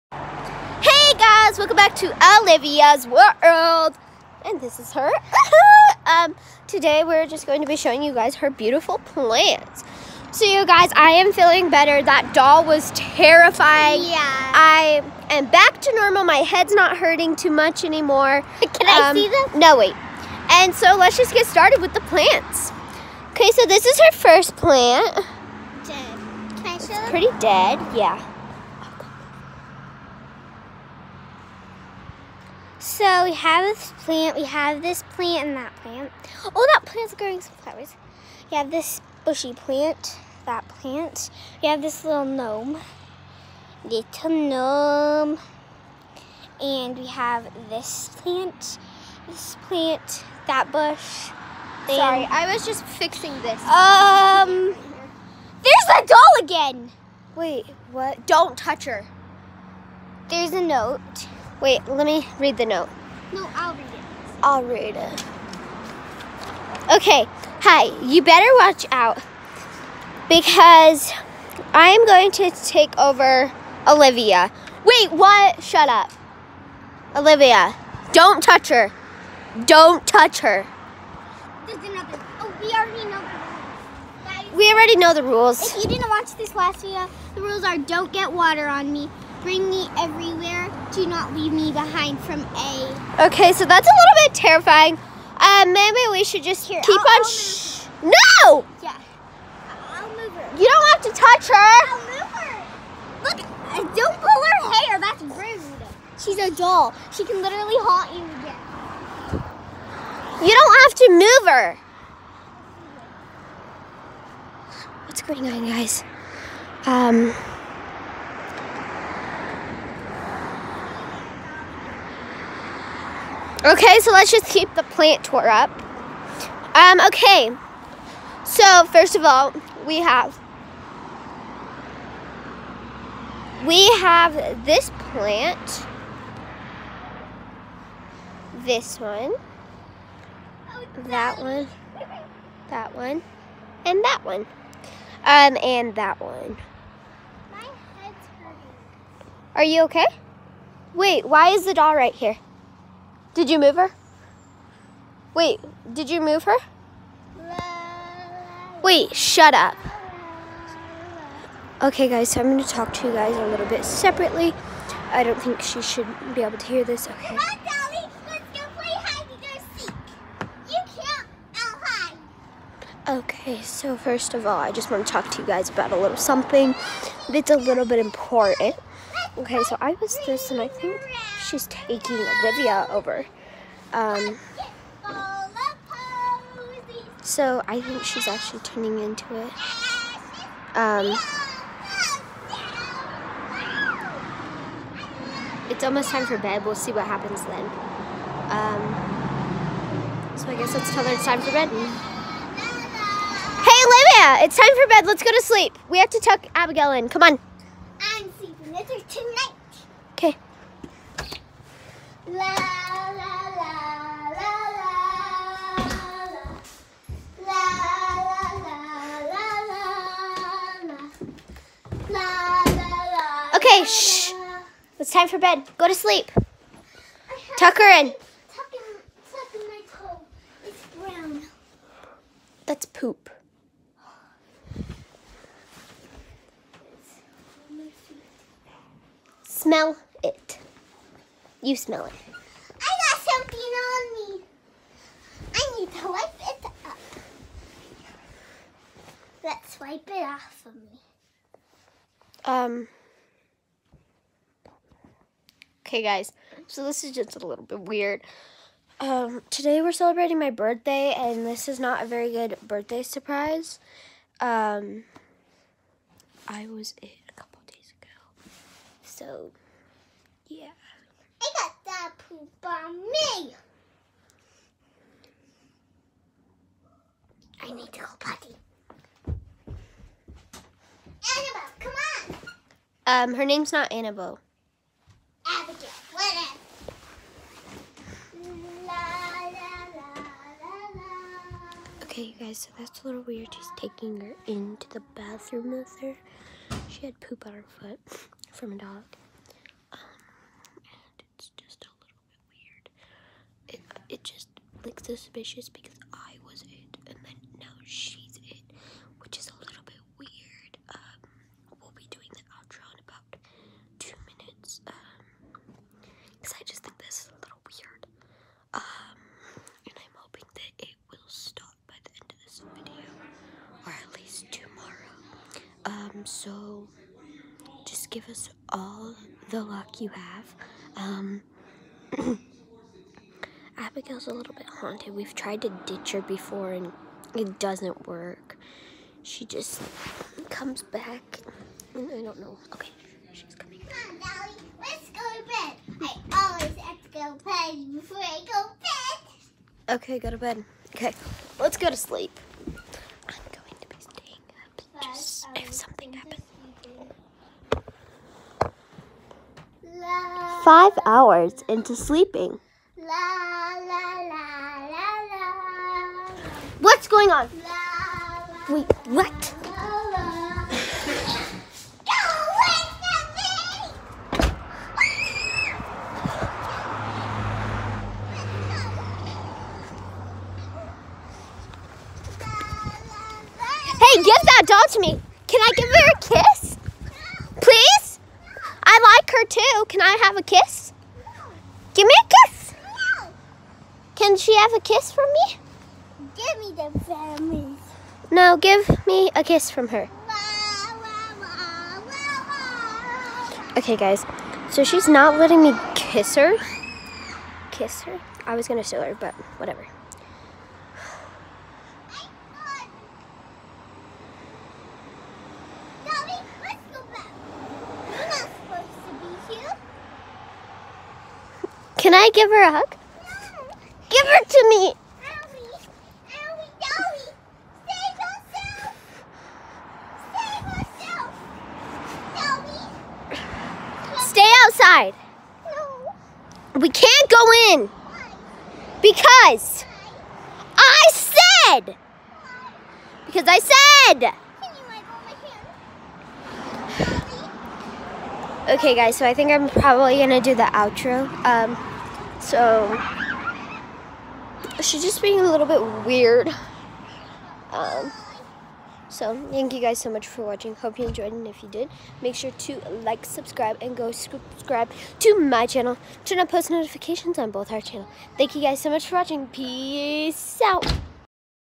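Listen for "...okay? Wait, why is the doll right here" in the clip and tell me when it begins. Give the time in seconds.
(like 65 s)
149 s.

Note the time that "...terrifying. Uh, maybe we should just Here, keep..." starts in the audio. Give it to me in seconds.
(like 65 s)
94 s.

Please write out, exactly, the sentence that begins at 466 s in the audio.
Turn on post notifications on both our channel.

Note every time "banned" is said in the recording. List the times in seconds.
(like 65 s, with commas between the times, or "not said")
not said.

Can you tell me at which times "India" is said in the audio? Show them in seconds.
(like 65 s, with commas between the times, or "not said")
not said.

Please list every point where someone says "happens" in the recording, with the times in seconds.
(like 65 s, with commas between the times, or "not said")
197 s, 356 s.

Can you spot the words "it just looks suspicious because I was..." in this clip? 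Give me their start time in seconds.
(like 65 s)
304 s.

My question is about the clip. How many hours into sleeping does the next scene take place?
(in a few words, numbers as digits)
5.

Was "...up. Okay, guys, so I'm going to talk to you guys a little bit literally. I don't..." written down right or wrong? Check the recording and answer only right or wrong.
wrong.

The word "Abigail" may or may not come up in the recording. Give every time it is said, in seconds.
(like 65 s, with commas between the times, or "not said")
206 s, 333 s.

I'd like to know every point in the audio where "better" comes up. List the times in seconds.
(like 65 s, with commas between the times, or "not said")
11 s, 68 s.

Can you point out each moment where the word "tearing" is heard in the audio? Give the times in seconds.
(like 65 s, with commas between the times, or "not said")
not said.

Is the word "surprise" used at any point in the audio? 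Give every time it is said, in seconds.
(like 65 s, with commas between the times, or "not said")
263 s.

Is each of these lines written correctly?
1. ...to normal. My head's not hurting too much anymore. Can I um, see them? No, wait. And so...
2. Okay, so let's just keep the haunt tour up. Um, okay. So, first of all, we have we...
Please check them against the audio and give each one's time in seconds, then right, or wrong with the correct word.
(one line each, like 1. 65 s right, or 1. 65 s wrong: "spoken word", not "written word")
1. 15 s right
2. 123 s wrong: "plant", not "haunt".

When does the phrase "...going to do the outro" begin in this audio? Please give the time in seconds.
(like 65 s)
450 s.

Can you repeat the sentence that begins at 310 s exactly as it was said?
Um, we'll be doing the outro in about two minutes.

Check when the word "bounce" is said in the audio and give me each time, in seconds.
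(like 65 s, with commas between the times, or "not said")
not said.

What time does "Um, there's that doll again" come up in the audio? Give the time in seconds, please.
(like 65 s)
53 s.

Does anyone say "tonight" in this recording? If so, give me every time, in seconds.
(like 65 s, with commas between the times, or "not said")
209 s.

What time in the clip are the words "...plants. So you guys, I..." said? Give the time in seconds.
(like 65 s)
8 s.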